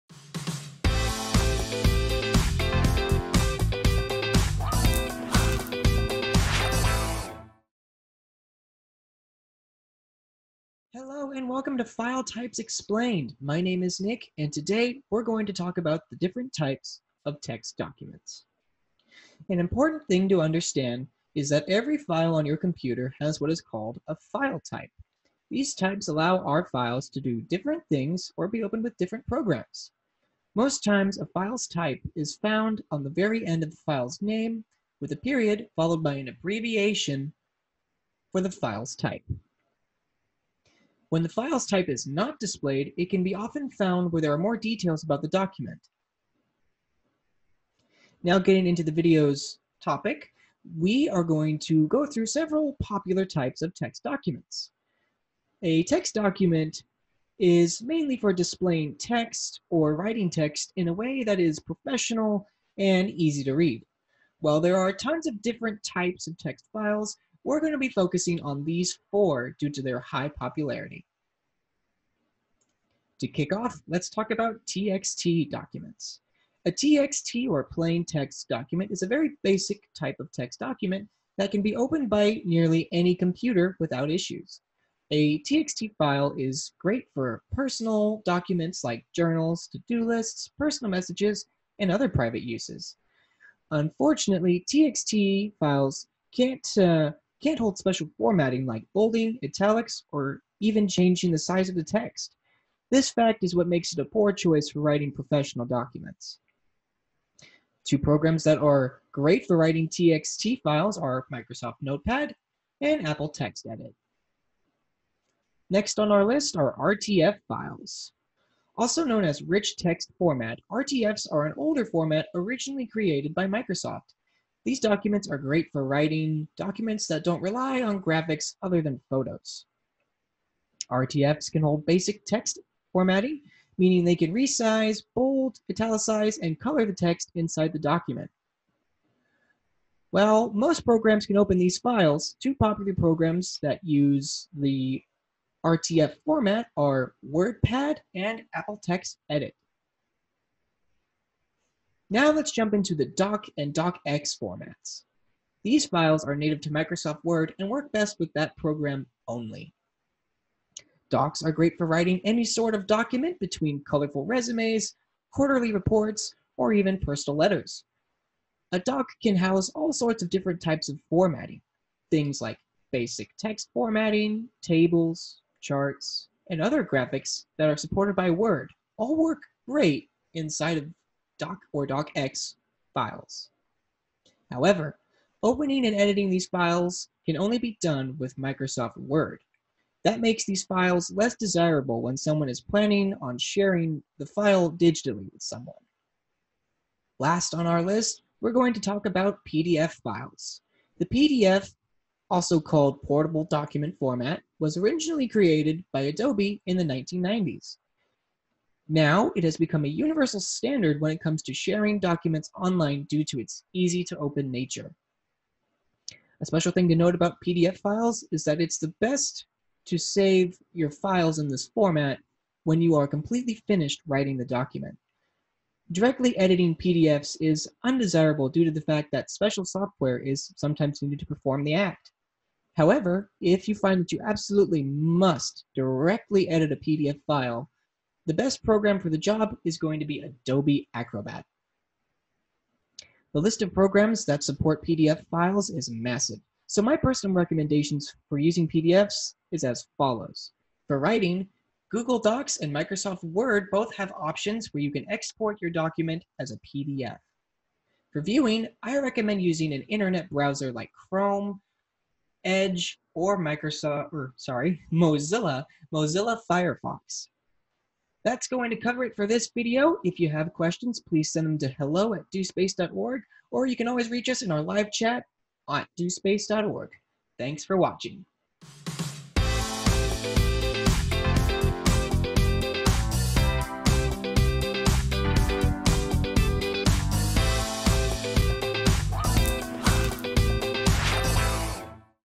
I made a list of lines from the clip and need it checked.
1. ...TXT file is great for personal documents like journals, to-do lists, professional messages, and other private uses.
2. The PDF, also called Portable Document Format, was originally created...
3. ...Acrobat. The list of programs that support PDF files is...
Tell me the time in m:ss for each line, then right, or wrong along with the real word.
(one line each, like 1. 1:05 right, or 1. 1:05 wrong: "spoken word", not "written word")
1. 1:25 wrong: "personal", not "professional"
2. 3:20 right
3. 4:00 right.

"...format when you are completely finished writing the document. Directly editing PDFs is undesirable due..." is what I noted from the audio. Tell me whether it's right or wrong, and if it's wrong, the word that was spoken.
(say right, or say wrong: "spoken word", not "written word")
right.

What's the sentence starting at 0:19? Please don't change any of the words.
An important thing to understand is that every file on your computer has what is called a file type.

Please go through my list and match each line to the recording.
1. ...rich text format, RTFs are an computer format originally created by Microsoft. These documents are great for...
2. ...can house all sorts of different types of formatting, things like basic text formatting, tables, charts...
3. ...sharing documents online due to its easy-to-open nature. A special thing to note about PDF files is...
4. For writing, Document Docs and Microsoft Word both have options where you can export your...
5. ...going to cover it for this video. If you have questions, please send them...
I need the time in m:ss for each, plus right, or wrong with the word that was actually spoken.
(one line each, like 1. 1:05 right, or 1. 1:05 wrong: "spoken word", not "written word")
1. 1:59 wrong: "older", not "computer"
2. 2:49 right
3. 3:31 right
4. 4:10 wrong: "Google", not "Document"
5. 4:28 right.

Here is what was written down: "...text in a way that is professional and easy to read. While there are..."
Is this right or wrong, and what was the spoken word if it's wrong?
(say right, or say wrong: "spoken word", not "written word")
right.